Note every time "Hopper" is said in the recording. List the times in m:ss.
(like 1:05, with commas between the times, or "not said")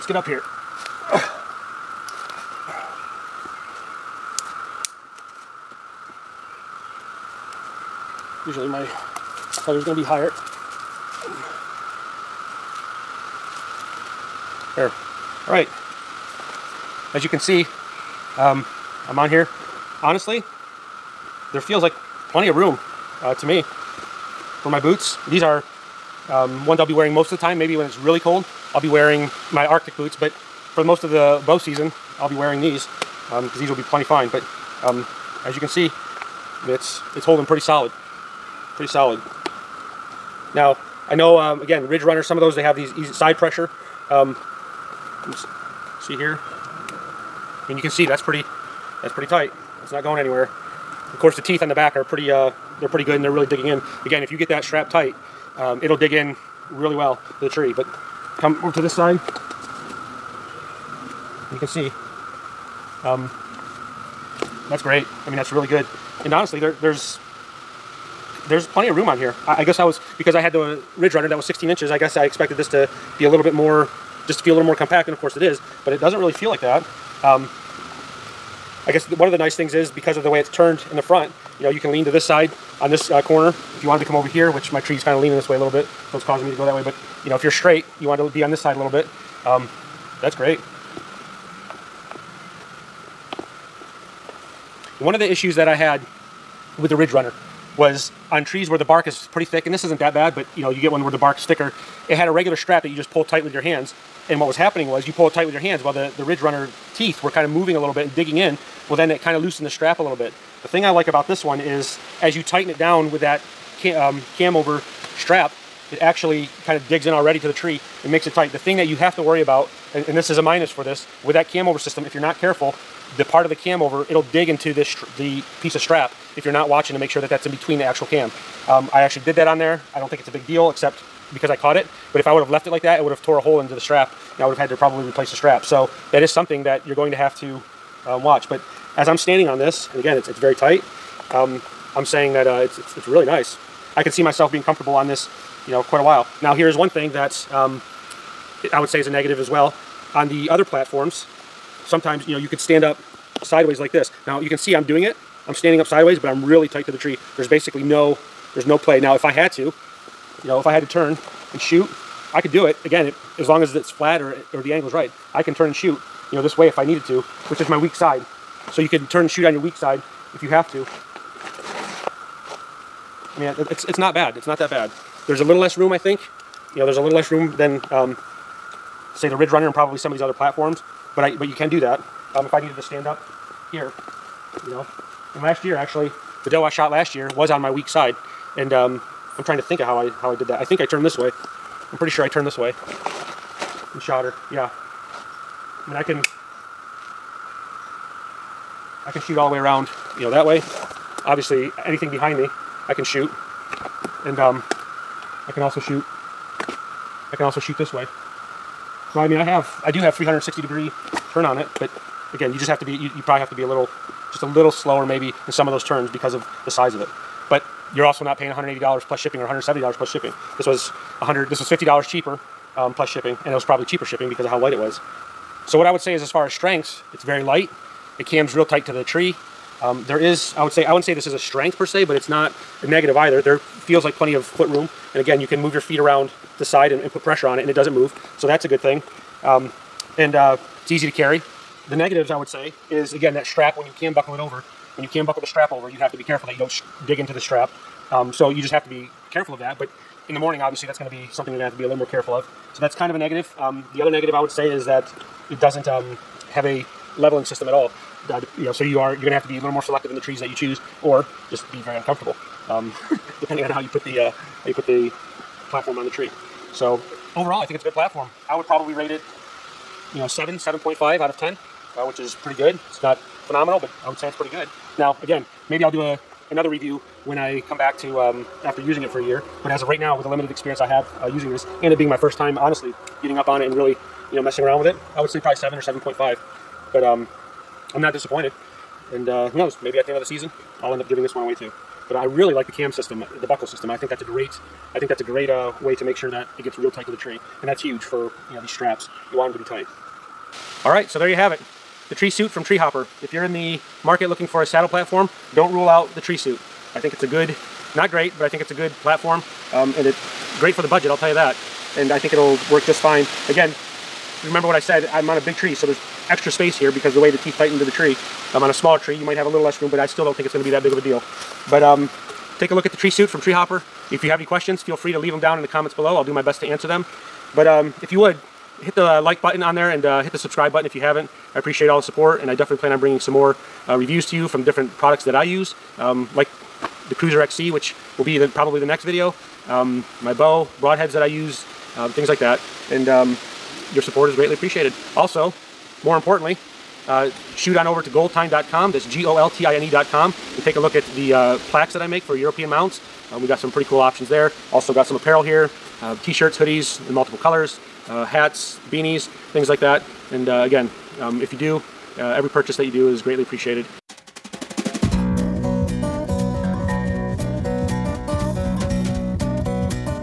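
5:02, 5:23.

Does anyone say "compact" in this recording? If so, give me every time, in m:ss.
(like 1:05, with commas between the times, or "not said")
1:14.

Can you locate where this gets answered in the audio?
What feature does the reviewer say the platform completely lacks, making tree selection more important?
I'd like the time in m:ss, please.
4:17.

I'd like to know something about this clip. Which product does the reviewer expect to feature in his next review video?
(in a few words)
Cruzr XC.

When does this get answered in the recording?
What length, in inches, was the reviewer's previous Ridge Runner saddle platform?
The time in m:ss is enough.
1:11.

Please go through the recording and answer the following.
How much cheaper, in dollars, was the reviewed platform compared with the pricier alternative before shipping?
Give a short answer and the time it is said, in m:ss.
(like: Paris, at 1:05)
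$50, at 3:41.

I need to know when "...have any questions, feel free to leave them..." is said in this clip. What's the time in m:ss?
5:24.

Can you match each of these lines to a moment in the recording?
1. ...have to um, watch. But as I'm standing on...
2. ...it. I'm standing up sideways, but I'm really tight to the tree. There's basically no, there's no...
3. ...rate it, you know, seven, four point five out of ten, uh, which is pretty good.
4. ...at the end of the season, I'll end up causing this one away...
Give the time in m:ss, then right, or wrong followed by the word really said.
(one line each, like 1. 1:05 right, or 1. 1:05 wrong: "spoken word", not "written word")
1. 2:17 right
2. 2:35 right
3. 4:28 wrong: "seven", not "four"
4. 4:49 wrong: "giving", not "causing".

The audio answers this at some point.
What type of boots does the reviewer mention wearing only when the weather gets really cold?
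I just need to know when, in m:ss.
0:29.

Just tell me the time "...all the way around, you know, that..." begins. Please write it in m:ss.
3:19.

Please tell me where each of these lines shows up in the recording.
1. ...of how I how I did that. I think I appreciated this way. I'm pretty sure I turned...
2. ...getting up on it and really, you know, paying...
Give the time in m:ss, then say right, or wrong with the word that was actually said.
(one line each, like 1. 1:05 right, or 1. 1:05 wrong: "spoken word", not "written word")
1. 3:09 wrong: "turned", not "appreciated"
2. 4:43 wrong: "messing", not "paying".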